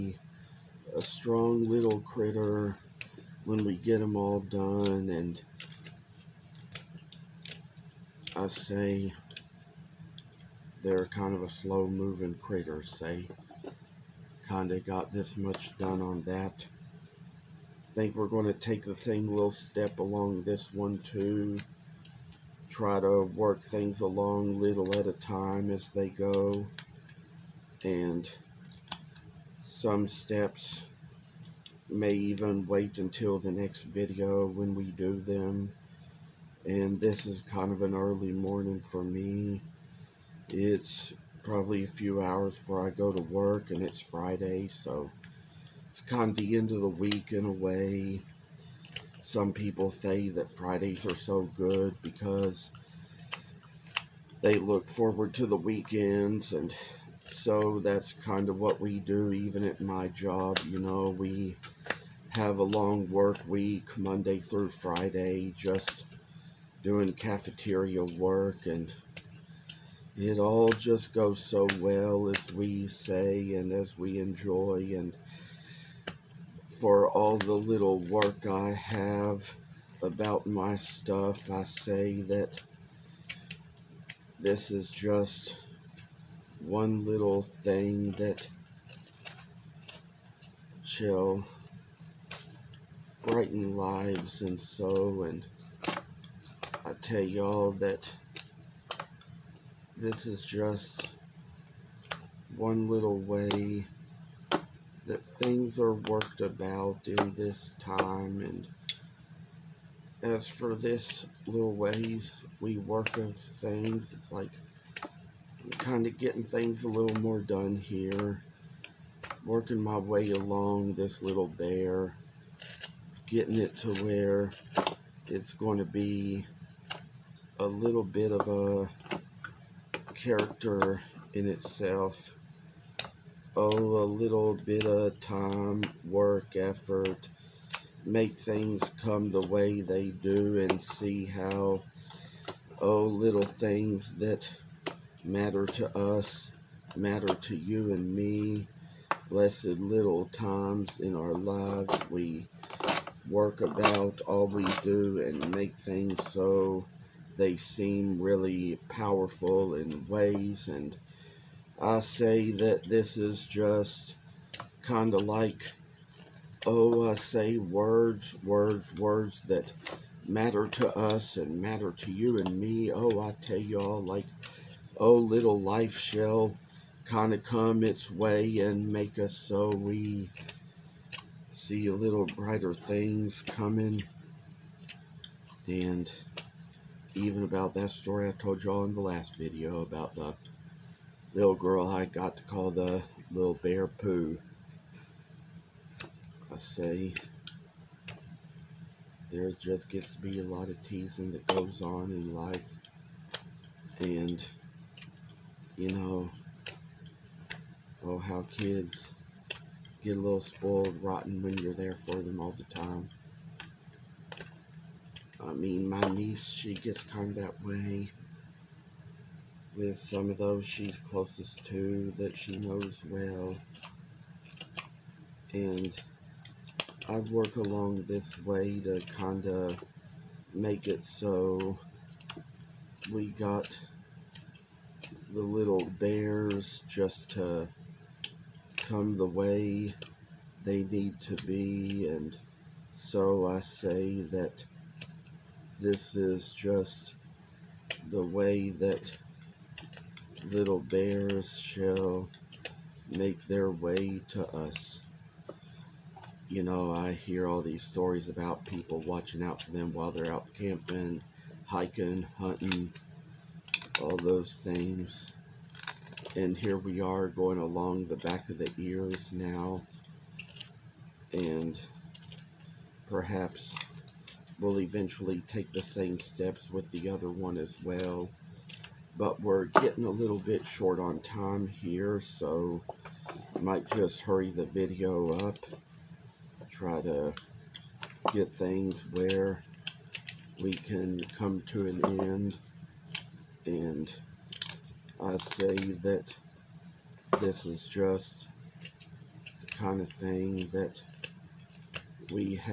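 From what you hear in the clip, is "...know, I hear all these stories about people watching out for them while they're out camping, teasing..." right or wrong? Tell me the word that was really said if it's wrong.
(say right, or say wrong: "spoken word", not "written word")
wrong: "hiking", not "teasing".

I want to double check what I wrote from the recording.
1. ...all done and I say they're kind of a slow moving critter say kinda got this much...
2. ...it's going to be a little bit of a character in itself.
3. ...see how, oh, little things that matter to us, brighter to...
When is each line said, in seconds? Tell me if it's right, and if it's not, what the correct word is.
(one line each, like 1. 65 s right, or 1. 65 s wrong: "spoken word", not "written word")
1. 4 s right
2. 125 s right
3. 140 s wrong: "matter", not "brighter".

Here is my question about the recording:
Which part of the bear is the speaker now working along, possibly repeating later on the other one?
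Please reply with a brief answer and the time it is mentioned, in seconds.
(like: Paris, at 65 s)
back of the ears, at 268 s.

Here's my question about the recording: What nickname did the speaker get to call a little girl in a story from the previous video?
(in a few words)
little bear poo.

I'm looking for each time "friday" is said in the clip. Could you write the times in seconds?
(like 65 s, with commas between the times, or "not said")
43 s, 50 s, 64 s.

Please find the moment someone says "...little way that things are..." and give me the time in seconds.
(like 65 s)
102 s.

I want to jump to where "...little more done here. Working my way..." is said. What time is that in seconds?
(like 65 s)
116 s.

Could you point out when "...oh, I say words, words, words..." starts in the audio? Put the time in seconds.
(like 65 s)
166 s.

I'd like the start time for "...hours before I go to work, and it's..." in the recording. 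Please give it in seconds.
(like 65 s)
42 s.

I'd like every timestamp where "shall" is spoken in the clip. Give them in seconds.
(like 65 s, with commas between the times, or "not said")
90 s, 175 s, 251 s.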